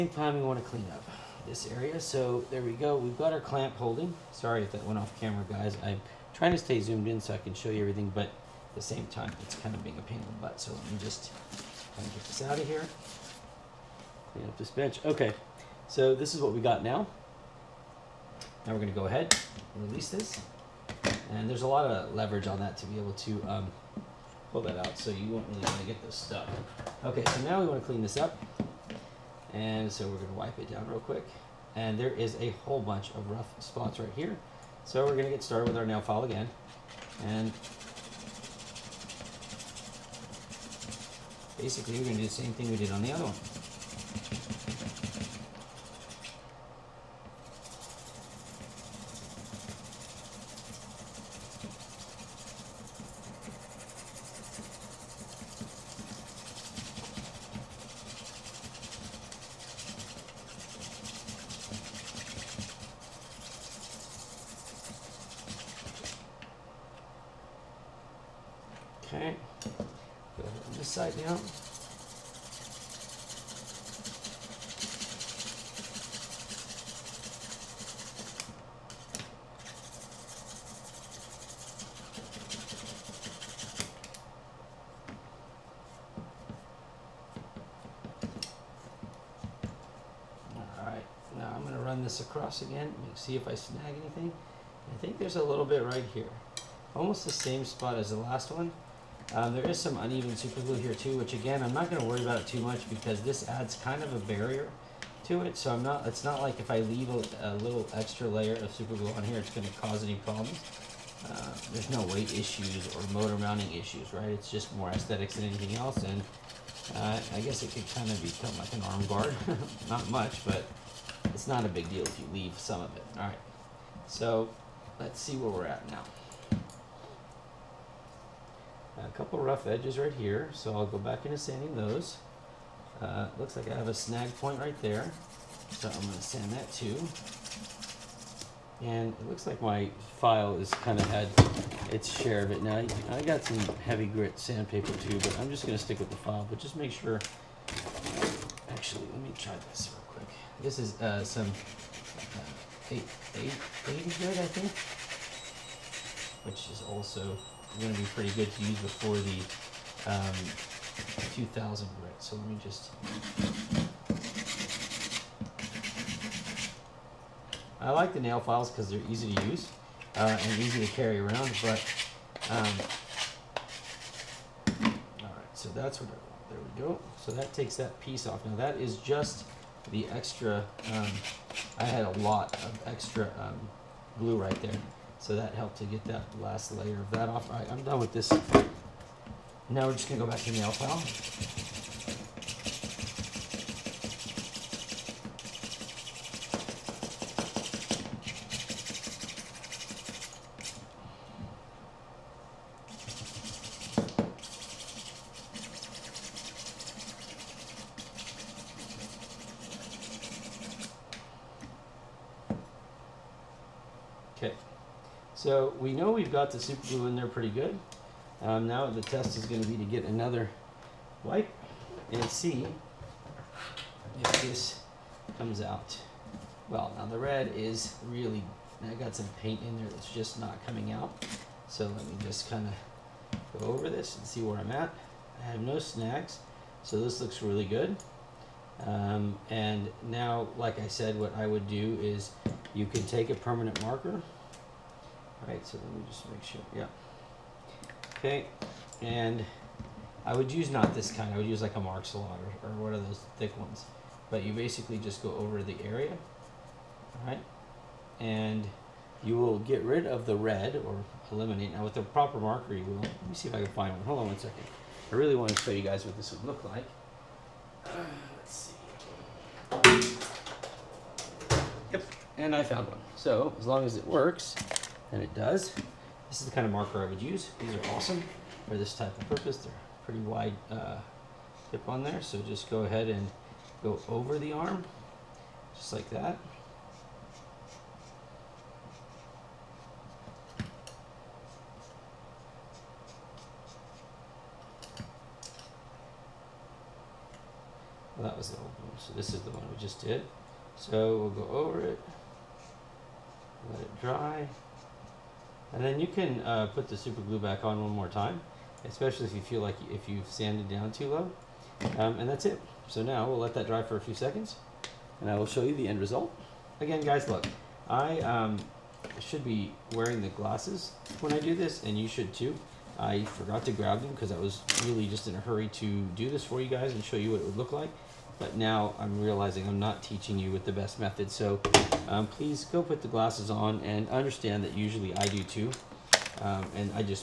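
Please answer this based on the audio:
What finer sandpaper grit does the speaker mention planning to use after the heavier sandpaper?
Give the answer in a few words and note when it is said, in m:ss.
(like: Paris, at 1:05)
2000 grit, at 2:41.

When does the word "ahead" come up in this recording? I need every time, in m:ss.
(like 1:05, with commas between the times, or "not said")
0:19, 4:42.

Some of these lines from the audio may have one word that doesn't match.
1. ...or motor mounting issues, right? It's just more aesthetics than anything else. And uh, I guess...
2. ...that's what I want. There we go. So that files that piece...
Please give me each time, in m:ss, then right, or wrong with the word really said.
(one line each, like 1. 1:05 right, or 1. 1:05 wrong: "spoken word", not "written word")
1. 1:52 right
2. 2:55 wrong: "takes", not "files".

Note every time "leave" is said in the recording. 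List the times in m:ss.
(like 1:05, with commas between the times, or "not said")
1:46, 2:02.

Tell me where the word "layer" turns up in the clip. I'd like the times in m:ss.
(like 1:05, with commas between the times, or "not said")
1:48, 3:06.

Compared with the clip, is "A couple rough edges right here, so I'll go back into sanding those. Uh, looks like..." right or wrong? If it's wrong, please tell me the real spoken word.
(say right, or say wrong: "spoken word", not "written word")
right.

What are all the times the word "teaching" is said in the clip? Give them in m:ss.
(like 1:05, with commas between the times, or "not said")
5:30.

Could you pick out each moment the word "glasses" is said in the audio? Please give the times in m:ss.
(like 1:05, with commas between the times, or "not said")
5:20, 5:33.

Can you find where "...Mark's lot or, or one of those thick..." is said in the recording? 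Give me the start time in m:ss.
4:11.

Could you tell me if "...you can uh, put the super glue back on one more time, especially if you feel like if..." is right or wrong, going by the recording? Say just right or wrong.
right.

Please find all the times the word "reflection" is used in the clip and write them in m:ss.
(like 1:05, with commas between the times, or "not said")
not said.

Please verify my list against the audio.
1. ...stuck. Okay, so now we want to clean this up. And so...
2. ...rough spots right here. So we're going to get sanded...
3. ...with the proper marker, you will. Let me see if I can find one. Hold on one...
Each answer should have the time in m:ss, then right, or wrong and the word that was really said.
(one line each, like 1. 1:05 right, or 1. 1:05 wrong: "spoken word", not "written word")
1. 0:26 right
2. 0:33 wrong: "started", not "sanded"
3. 4:21 right.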